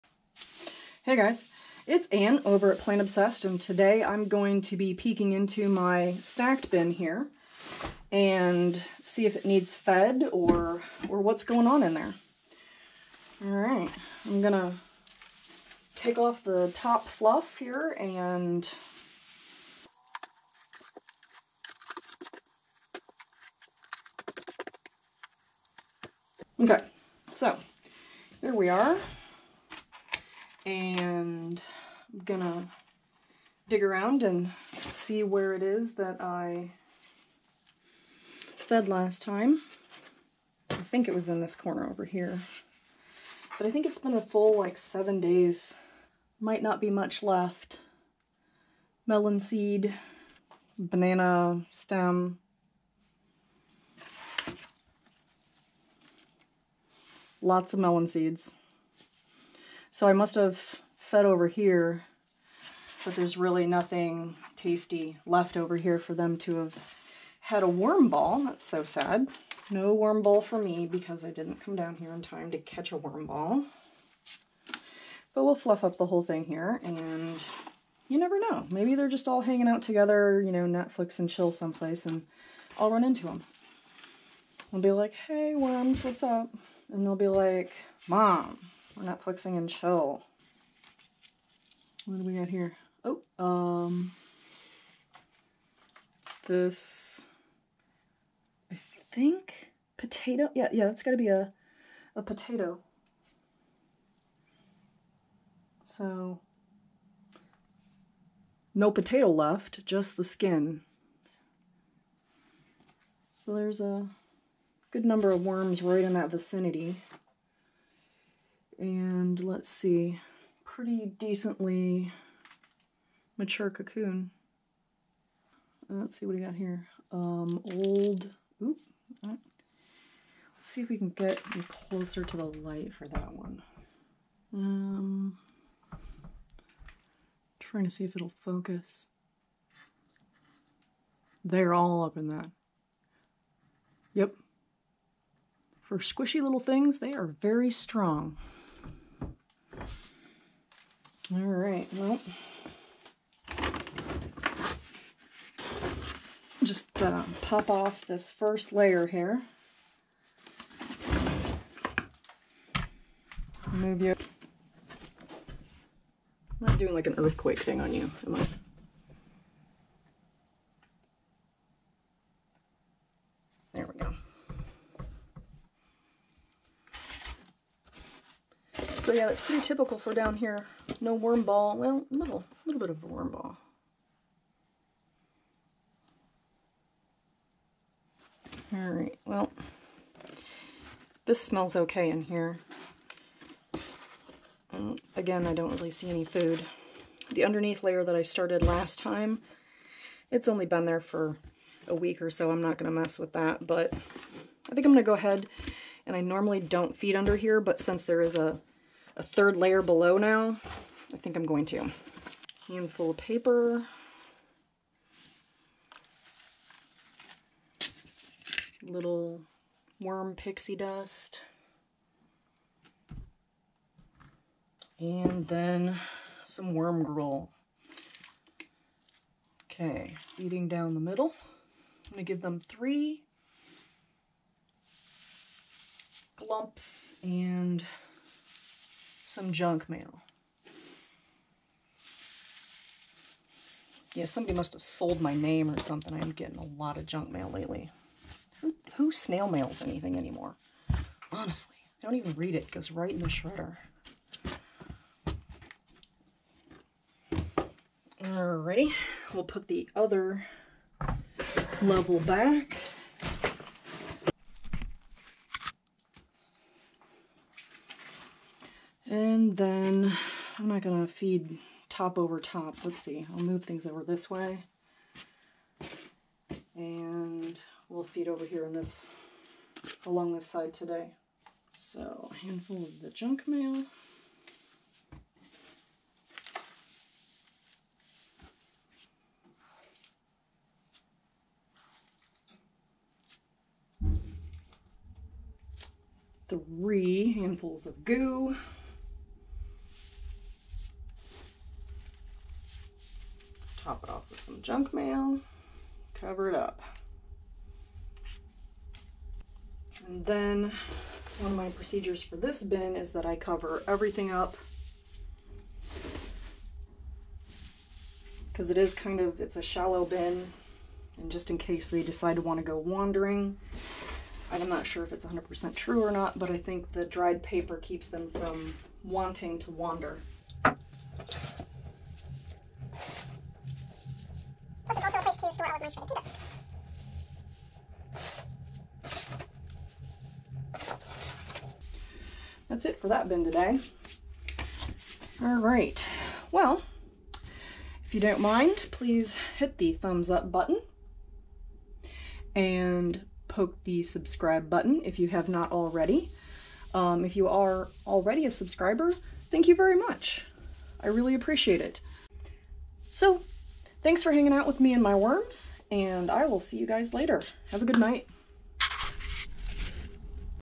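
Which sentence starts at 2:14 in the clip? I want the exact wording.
Um, trying to see if it'll focus.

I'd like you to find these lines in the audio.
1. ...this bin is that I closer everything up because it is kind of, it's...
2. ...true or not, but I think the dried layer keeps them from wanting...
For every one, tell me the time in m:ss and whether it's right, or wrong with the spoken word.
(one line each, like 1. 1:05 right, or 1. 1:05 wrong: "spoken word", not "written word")
1. 5:12 wrong: "cover", not "closer"
2. 5:25 wrong: "paper", not "layer".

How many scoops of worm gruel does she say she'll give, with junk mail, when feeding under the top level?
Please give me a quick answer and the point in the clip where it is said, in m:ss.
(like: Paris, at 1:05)
3, at 3:52.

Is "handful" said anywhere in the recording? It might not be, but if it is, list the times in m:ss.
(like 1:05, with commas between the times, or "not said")
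3:32, 4:42, 4:57.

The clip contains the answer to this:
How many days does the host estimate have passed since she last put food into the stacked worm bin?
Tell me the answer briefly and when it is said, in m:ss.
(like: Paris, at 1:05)
7, at 0:44.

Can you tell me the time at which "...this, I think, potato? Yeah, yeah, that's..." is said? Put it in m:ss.
1:36.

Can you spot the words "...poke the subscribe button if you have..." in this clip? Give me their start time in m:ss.
5:53.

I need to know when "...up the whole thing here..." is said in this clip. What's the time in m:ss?
1:15.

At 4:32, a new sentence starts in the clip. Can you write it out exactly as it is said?
Let's see, I'll move things over this way.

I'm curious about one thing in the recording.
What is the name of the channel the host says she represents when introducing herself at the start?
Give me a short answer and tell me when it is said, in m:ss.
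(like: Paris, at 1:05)
Plant Obsessed, at 0:02.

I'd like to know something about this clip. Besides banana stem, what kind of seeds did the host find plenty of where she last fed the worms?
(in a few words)
Melon seeds.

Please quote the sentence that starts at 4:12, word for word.
It goes right in the shredder.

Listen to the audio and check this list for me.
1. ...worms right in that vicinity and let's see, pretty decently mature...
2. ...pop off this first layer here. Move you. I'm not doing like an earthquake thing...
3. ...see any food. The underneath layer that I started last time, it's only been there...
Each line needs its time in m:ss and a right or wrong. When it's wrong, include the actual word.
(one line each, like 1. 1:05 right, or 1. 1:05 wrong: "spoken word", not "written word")
1. 1:55 right
2. 2:37 right
3. 3:15 right.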